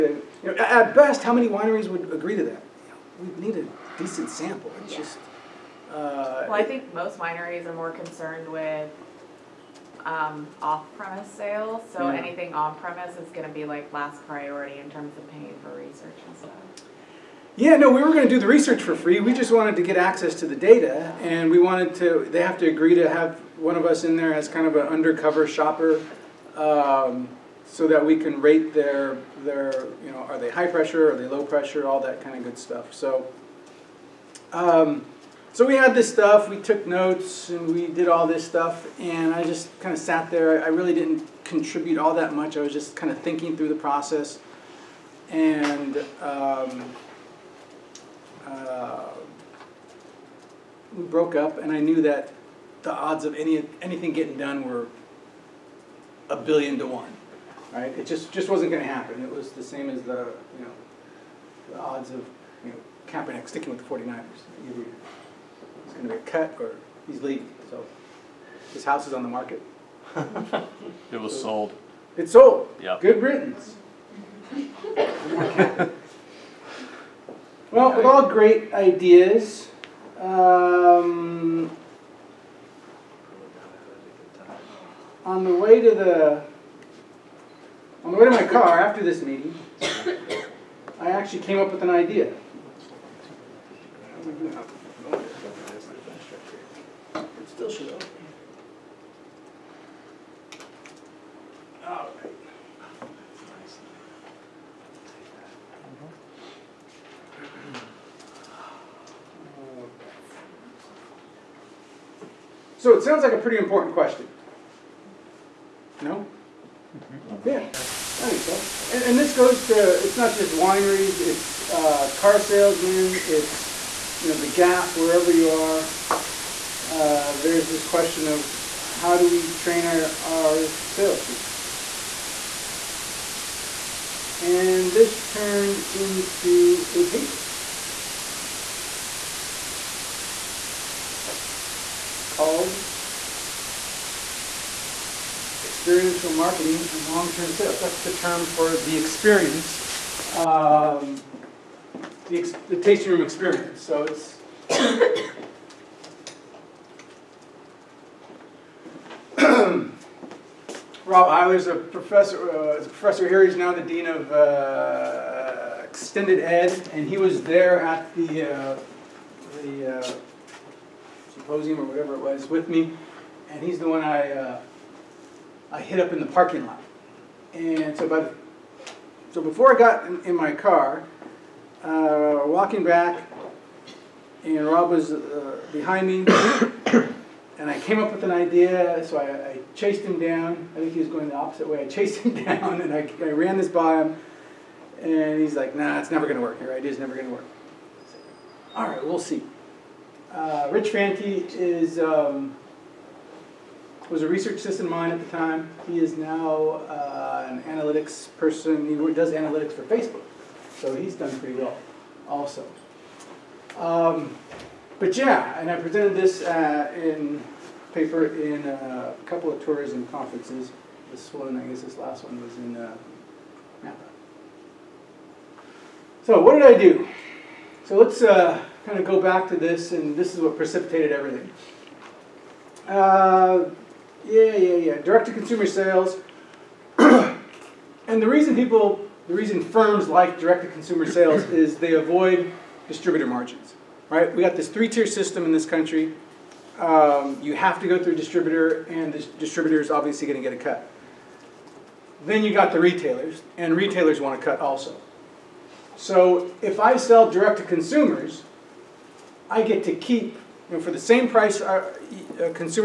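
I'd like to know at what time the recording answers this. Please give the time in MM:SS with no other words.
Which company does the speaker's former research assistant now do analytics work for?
03:29.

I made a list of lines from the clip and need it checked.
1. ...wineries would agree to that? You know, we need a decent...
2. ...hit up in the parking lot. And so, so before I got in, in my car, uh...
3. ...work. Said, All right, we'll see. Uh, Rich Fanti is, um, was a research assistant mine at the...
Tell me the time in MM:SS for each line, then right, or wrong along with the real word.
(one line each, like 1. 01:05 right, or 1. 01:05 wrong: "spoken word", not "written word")
1. 00:01 right
2. 02:55 right
3. 03:17 right.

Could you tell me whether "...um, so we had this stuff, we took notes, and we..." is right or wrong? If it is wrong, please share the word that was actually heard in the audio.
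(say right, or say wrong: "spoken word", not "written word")
right.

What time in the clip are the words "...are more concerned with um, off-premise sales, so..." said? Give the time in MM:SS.
00:07.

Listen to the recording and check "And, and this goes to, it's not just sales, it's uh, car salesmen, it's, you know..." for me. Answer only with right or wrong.
wrong.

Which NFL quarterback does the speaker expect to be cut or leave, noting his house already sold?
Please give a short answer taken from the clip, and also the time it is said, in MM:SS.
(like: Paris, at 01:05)
Kaepernick, at 01:03.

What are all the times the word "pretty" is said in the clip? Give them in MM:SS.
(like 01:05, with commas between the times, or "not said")
01:53, 03:31.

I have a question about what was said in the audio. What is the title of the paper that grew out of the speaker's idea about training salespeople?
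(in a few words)
Experiential marketing and long-term sales.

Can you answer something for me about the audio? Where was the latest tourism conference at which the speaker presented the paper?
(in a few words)
Napa.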